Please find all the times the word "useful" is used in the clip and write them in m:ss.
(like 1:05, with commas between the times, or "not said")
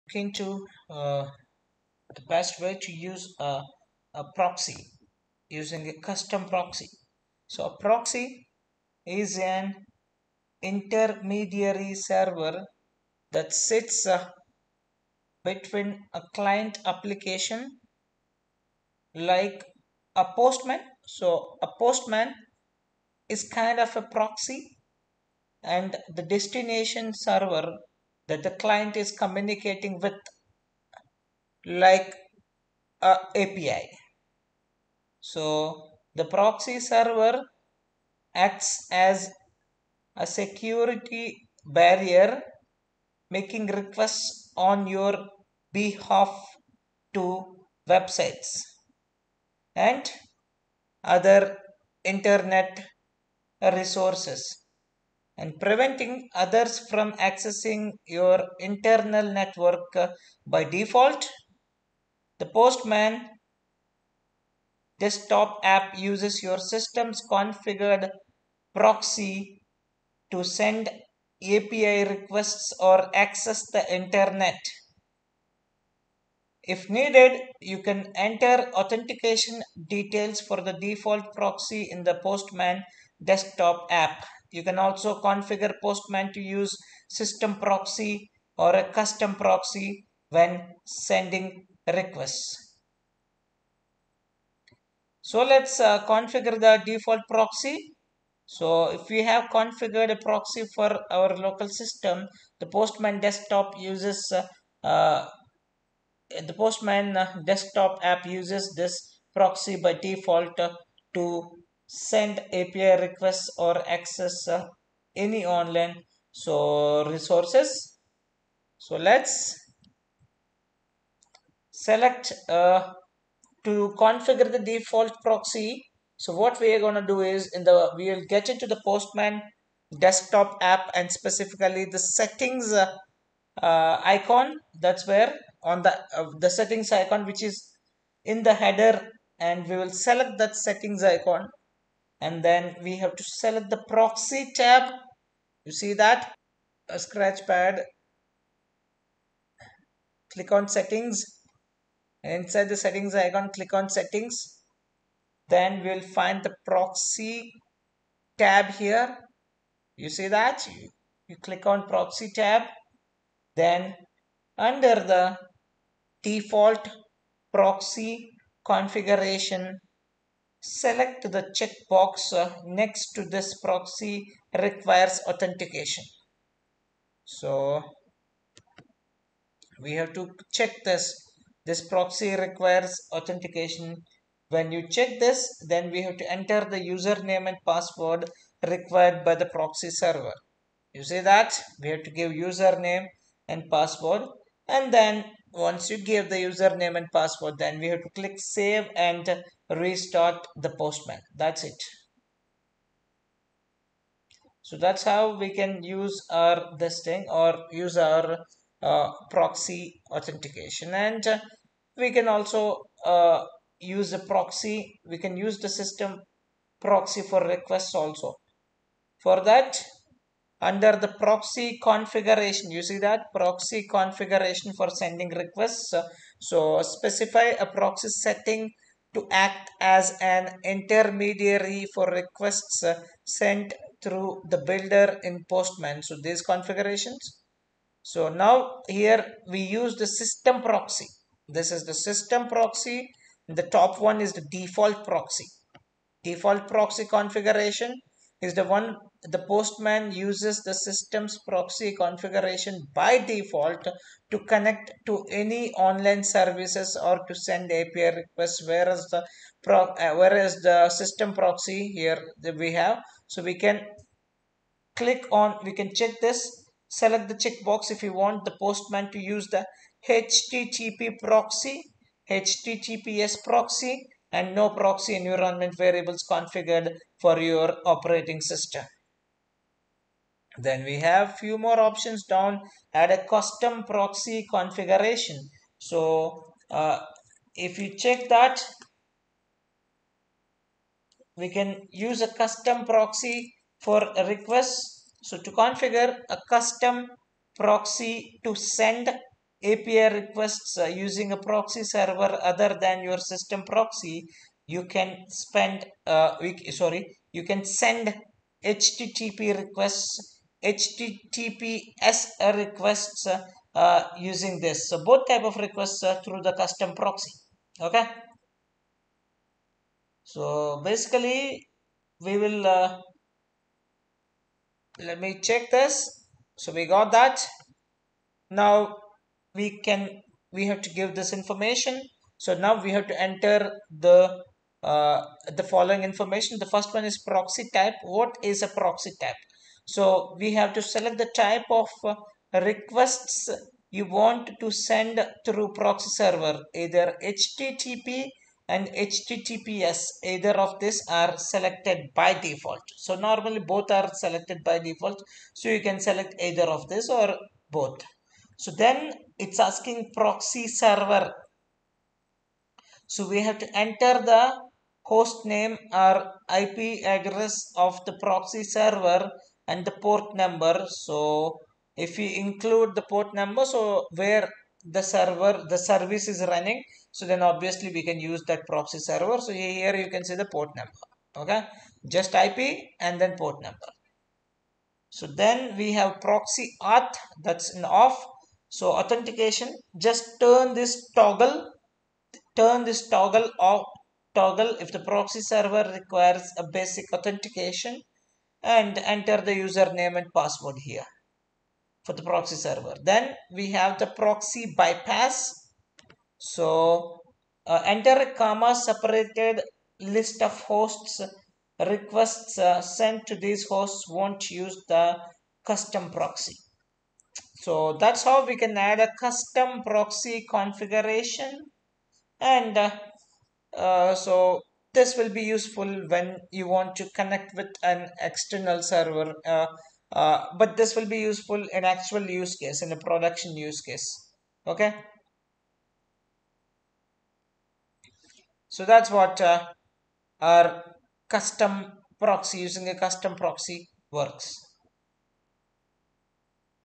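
7:05, 7:11.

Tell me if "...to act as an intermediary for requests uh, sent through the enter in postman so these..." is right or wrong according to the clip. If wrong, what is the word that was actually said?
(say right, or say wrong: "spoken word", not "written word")
wrong: "builder", not "enter".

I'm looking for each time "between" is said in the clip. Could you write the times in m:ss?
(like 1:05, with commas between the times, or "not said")
0:15.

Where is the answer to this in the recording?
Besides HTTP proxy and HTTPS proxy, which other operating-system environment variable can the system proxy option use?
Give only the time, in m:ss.
4:34.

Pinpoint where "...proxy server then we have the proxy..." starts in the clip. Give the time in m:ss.
6:42.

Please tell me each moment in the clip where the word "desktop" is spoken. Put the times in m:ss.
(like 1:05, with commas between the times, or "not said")
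1:04, 1:23, 1:43, 1:47, 2:09.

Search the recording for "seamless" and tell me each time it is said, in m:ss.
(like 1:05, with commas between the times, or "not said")
not said.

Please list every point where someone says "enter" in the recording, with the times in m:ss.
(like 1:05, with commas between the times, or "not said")
1:18, 3:06, 5:33, 6:03, 6:39, 6:47.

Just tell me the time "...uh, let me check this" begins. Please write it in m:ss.
5:22.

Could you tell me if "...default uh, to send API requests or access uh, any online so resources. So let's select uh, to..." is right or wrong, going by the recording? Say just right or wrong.
right.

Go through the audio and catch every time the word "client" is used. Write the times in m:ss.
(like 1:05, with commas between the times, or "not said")
0:16, 0:28.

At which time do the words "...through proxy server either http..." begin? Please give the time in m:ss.
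5:45.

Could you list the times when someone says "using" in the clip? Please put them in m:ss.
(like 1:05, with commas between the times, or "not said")
0:05, 5:00, 5:14, 7:22.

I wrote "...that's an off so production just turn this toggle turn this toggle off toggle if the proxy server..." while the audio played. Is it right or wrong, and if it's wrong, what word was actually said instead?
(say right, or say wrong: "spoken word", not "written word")
wrong: "authentication", not "production".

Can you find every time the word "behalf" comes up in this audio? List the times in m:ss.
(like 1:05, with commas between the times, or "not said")
0:45.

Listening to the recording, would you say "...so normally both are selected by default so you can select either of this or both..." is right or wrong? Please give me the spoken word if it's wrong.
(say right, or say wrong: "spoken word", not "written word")
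right.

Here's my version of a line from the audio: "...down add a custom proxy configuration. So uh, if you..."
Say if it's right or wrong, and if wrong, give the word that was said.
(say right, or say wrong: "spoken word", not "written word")
right.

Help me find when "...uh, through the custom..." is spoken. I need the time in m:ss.
5:16.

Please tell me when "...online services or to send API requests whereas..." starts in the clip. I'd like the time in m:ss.
4:15.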